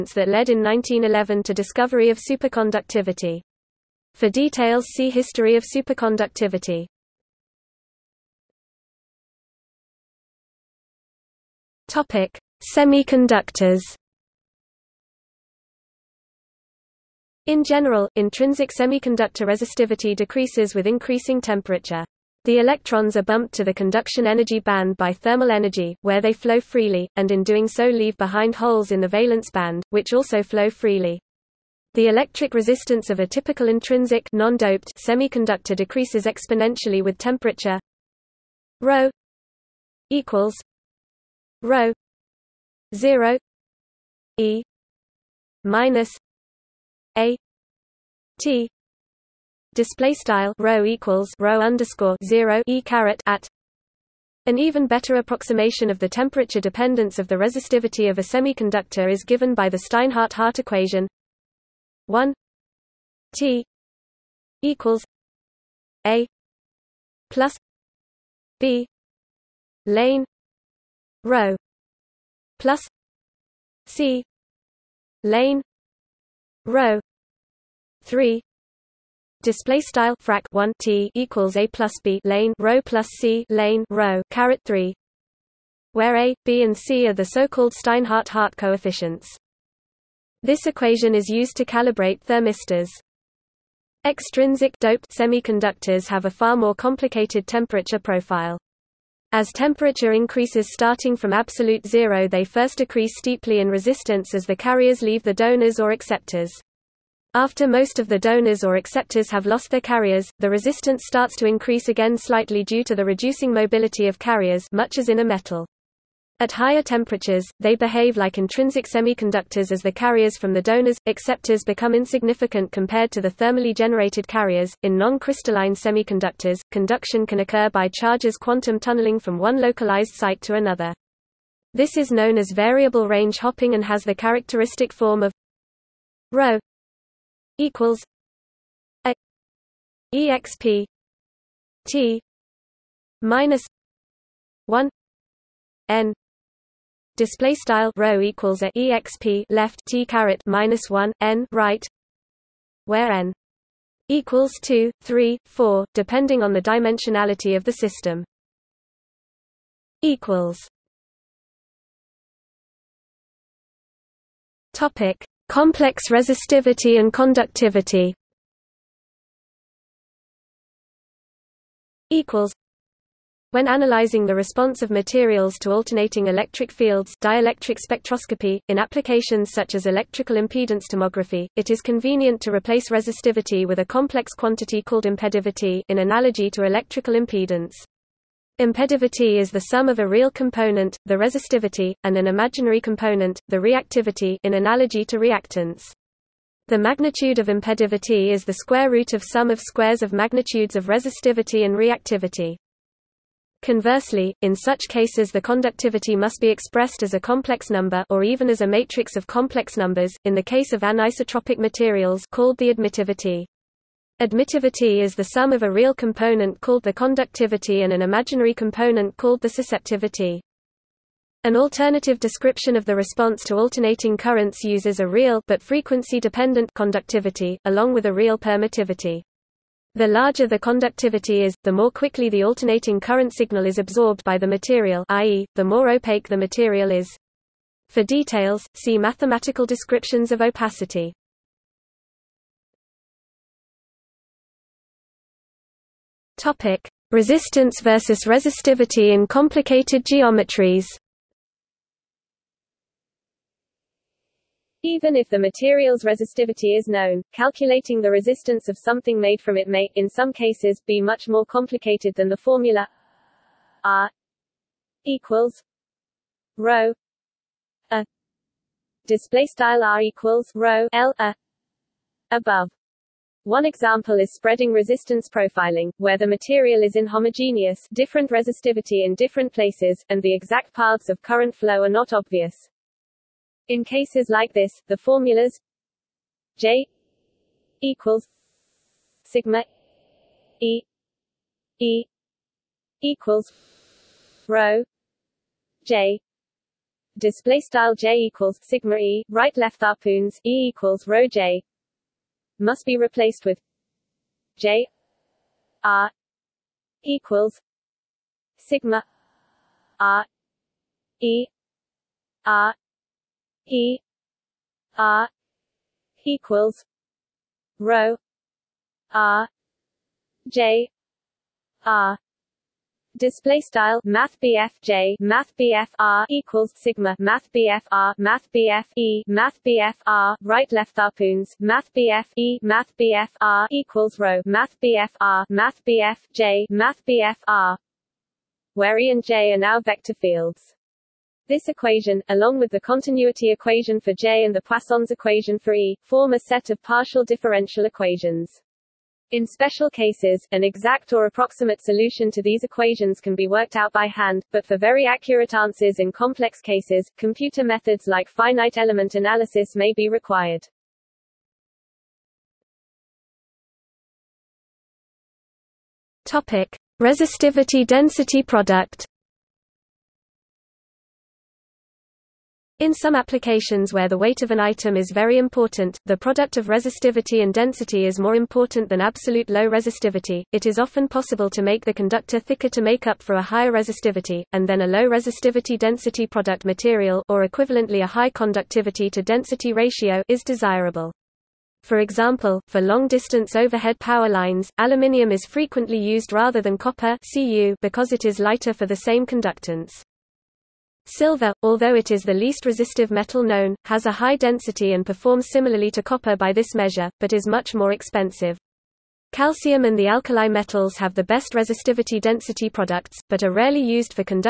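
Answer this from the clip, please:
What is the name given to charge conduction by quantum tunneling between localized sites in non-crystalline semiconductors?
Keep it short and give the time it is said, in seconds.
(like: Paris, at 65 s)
Variable range hopping, at 132 s.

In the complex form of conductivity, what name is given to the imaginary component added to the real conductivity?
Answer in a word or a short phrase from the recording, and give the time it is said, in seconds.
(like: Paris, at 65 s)
Susceptivity, at 219 s.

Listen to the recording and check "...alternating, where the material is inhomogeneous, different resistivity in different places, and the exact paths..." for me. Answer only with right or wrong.
wrong.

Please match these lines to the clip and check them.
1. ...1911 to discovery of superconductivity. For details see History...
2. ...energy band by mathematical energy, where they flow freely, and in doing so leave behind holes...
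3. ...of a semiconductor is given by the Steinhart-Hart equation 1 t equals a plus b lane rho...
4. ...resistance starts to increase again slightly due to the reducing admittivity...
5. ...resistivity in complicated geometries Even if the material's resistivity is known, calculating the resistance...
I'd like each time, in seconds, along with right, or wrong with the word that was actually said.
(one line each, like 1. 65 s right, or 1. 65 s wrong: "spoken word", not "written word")
1. 0 s right
2. 24 s wrong: "thermal", not "mathematical"
3. 58 s right
4. 110 s wrong: "mobility", not "admittivity"
5. 248 s right.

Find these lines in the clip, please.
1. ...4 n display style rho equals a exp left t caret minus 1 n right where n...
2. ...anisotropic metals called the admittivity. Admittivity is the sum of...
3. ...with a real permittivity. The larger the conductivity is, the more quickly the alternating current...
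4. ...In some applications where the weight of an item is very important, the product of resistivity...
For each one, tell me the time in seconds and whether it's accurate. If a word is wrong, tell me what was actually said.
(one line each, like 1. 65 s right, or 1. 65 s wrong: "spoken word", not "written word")
1. 144 s wrong: "1", not "4"
2. 210 s wrong: "materials", not "metals"
3. 227 s right
4. 372 s right.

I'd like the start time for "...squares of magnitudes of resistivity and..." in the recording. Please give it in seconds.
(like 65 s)
199 s.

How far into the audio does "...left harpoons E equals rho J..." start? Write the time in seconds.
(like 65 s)
299 s.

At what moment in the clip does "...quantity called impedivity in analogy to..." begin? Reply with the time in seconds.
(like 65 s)
184 s.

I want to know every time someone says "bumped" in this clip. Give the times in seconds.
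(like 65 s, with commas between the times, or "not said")
23 s.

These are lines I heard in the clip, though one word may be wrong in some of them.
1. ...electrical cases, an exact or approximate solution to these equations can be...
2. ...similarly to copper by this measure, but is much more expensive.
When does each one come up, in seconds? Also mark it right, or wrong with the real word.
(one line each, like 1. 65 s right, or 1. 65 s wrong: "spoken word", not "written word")
1. 349 s wrong: "special", not "electrical"
2. 405 s right.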